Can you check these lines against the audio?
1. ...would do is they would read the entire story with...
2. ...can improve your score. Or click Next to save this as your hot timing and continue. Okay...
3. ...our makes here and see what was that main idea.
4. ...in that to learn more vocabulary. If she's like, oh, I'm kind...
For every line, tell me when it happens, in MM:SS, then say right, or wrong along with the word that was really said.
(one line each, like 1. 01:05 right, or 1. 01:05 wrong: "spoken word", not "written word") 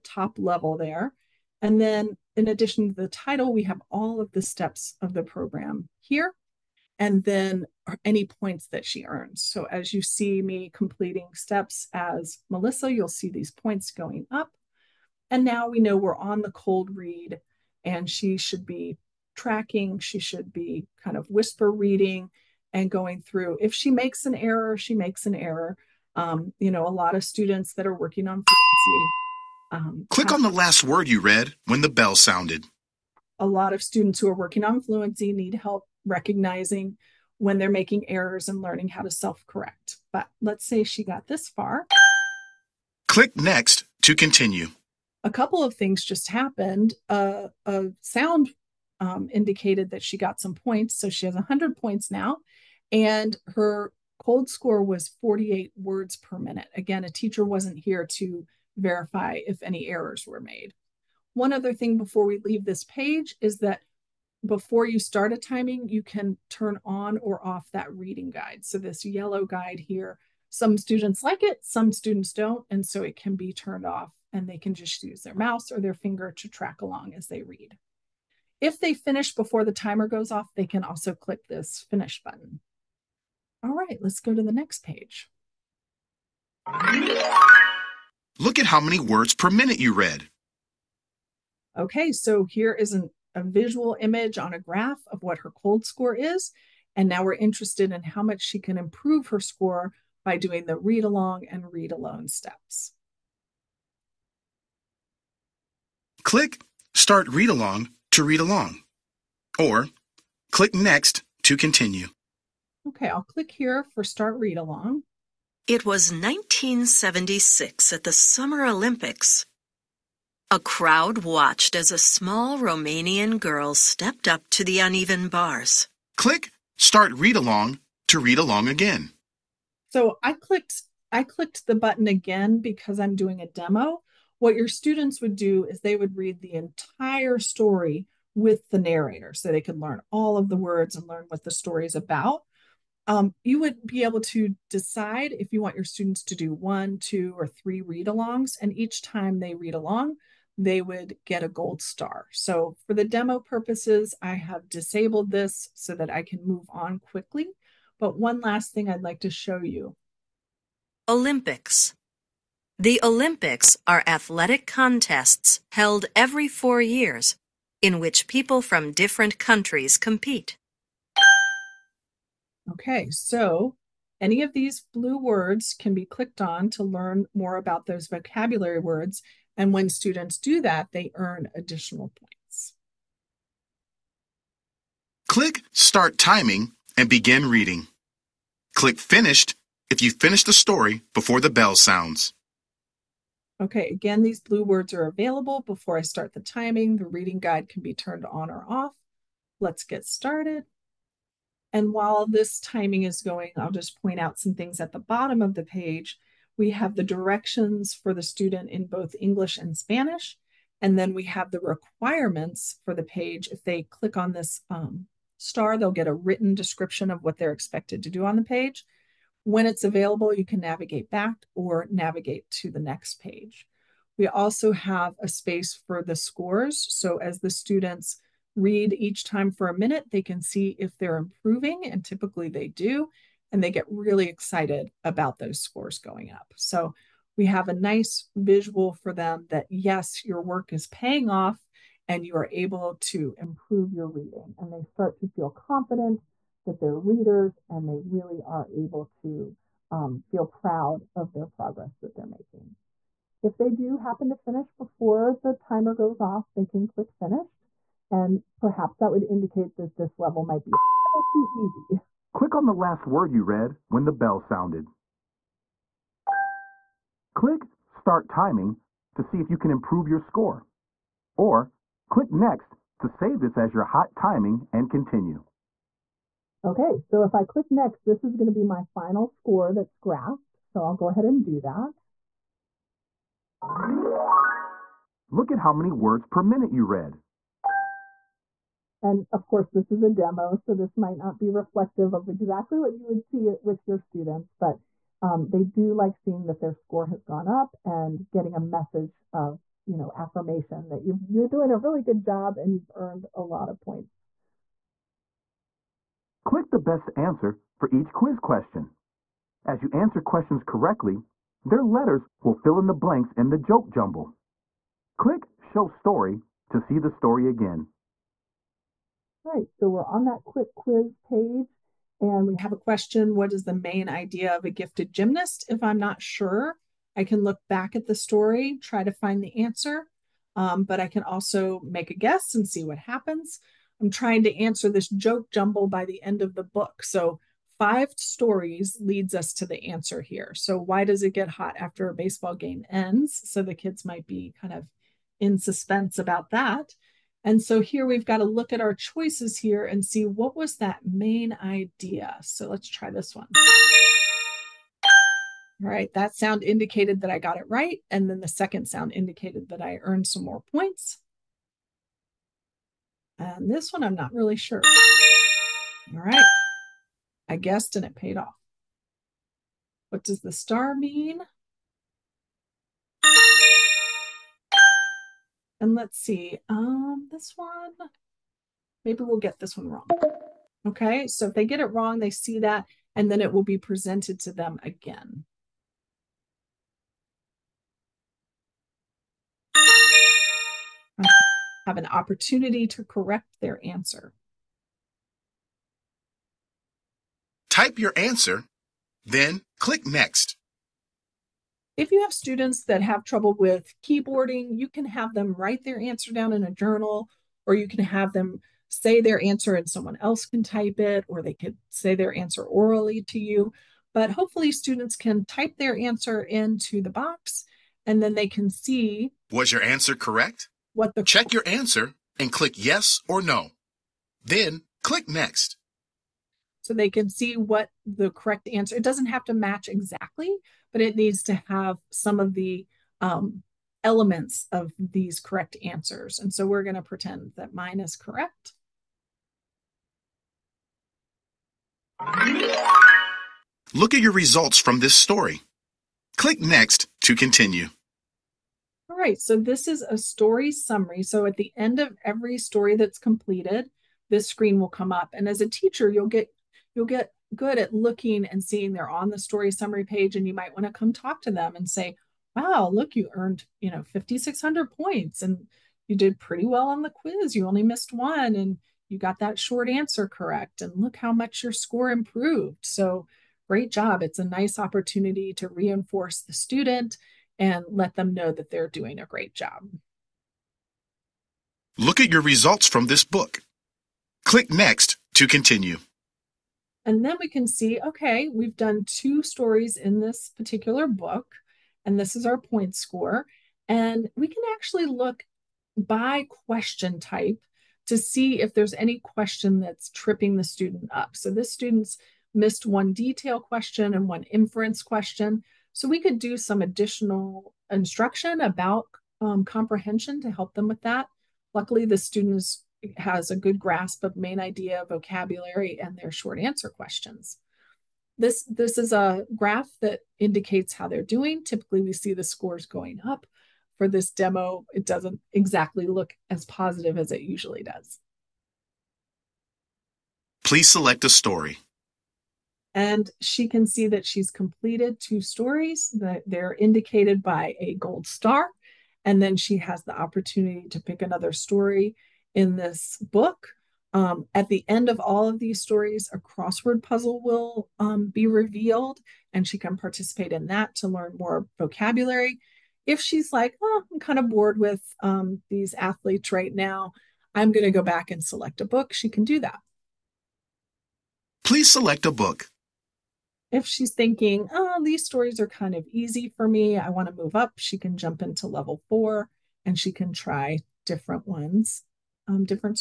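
1. 02:15 right
2. 04:29 right
3. 05:48 wrong: "choices", not "makes"
4. 09:10 right.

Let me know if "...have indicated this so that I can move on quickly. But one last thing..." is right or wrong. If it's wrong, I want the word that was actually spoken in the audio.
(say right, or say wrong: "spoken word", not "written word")
wrong: "disabled", not "indicated".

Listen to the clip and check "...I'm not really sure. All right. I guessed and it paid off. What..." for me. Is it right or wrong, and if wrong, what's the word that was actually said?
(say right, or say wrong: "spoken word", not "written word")
right.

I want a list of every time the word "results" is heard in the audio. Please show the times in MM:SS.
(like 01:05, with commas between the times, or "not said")
07:24, 08:02.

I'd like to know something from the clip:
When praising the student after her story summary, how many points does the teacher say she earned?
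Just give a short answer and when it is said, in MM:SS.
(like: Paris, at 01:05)
5600, at 07:44.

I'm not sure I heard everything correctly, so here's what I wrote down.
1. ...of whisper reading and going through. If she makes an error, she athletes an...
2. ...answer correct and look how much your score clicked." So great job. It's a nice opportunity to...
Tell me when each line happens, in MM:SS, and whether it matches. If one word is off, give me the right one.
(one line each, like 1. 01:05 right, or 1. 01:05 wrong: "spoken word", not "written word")
1. 00:21 wrong: "makes", not "athletes"
2. 07:49 wrong: "improved", not "clicked".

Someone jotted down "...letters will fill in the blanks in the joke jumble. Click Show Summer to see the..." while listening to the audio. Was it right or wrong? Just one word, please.
wrong.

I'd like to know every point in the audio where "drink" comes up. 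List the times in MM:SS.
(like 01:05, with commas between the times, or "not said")
not said.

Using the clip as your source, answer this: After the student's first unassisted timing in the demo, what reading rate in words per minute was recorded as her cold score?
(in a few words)
48.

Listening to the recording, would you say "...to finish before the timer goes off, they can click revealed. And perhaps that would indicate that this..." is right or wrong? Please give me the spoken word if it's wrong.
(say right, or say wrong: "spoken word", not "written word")
wrong: "finished", not "revealed".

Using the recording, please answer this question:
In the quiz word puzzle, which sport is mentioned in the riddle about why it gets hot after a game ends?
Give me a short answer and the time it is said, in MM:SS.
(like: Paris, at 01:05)
baseball, at 05:42.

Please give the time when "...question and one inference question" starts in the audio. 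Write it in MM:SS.
08:23.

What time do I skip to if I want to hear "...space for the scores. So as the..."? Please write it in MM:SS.
03:45.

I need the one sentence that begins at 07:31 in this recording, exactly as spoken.
So at the end of every story that's completed, this screen will come up.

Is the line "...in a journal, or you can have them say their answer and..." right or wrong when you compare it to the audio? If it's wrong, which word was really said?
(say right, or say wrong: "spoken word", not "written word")
right.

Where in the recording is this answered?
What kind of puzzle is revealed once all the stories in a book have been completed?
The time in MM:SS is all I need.
09:06.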